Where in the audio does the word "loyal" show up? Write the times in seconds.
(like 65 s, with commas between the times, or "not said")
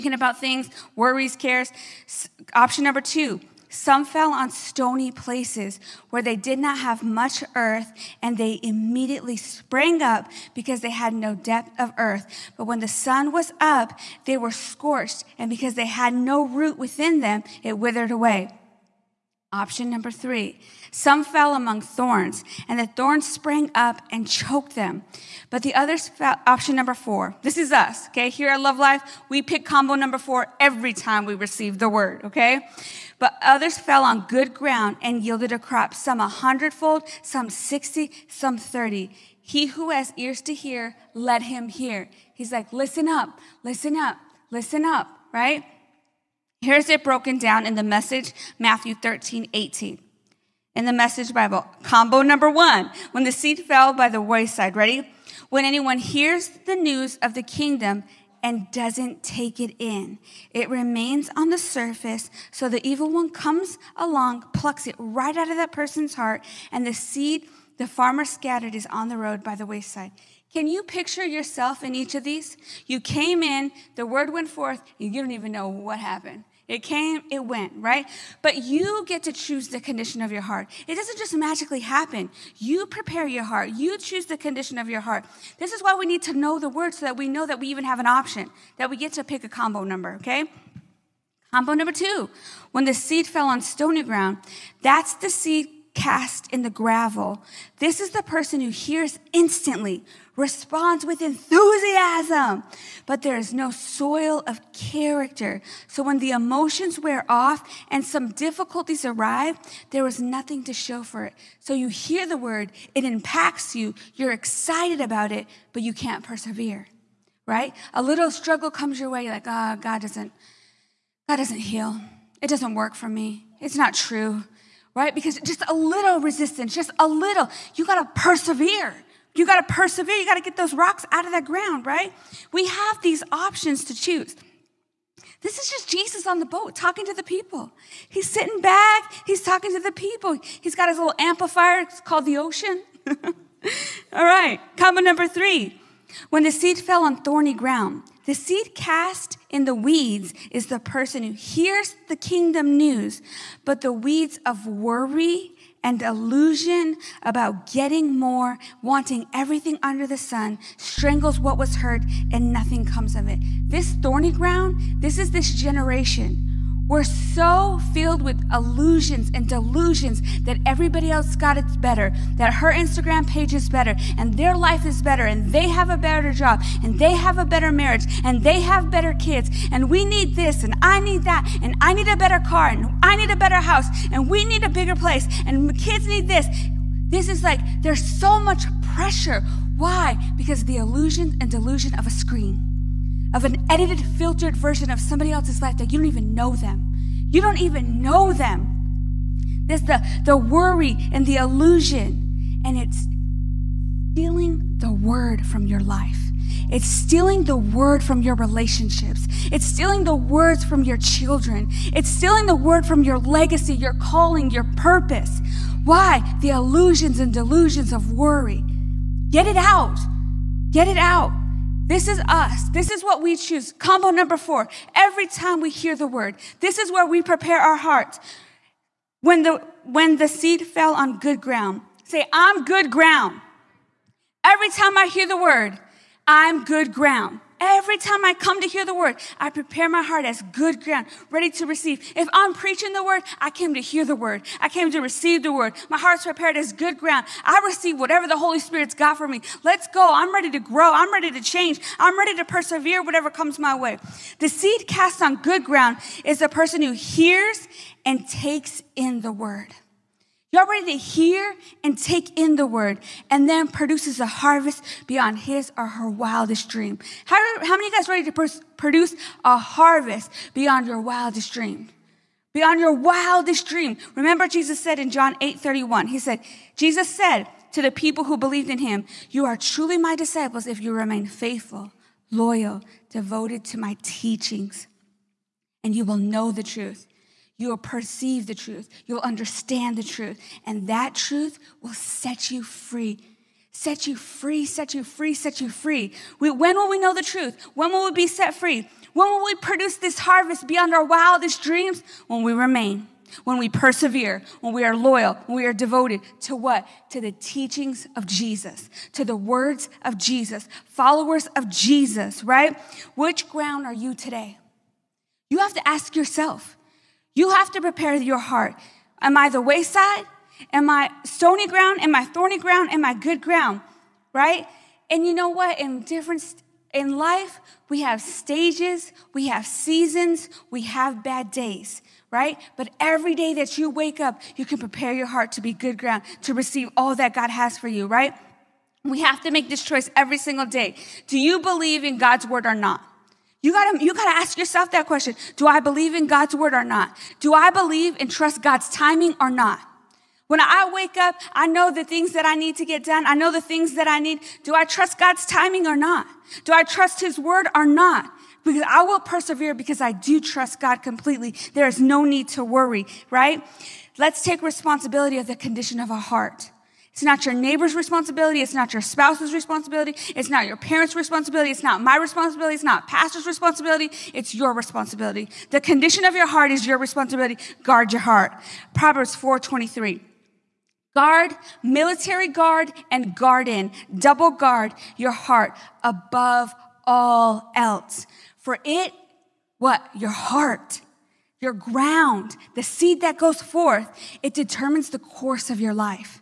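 282 s, 304 s.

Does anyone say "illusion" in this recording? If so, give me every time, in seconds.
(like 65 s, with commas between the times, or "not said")
156 s, 168 s, 190 s, 201 s, 216 s.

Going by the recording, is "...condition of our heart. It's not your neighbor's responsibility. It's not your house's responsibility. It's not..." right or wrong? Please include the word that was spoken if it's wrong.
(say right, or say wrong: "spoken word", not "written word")
wrong: "spouse", not "house".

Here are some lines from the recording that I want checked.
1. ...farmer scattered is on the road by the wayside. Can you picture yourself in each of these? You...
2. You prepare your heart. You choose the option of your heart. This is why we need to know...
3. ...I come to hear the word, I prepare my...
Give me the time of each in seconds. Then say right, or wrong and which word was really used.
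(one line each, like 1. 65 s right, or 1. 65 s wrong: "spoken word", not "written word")
1. 67 s right
2. 82 s wrong: "condition", not "option"
3. 238 s right.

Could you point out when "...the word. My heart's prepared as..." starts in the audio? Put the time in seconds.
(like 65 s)
245 s.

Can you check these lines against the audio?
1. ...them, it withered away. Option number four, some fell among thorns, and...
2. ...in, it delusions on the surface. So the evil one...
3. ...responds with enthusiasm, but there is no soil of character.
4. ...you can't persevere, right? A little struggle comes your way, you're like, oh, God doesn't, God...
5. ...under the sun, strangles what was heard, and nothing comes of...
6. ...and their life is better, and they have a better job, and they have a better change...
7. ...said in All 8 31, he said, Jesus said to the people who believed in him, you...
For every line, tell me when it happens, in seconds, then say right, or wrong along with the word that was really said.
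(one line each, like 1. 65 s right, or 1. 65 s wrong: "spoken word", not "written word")
1. 17 s wrong: "three", not "four"
2. 59 s wrong: "remains", not "delusions"
3. 100 s right
4. 115 s right
5. 159 s right
6. 174 s wrong: "marriage", not "change"
7. 274 s wrong: "John", not "All".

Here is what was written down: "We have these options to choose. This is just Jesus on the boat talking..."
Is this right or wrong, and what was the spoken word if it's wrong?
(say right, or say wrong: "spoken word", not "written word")
right.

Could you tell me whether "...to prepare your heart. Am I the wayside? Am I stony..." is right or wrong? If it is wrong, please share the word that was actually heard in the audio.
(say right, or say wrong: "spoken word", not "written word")
right.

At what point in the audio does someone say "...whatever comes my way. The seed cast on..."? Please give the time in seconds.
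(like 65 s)
253 s.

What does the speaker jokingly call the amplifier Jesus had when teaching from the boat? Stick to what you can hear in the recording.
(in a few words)
The ocean.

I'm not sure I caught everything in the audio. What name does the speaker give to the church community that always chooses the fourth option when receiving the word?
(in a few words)
Love Life.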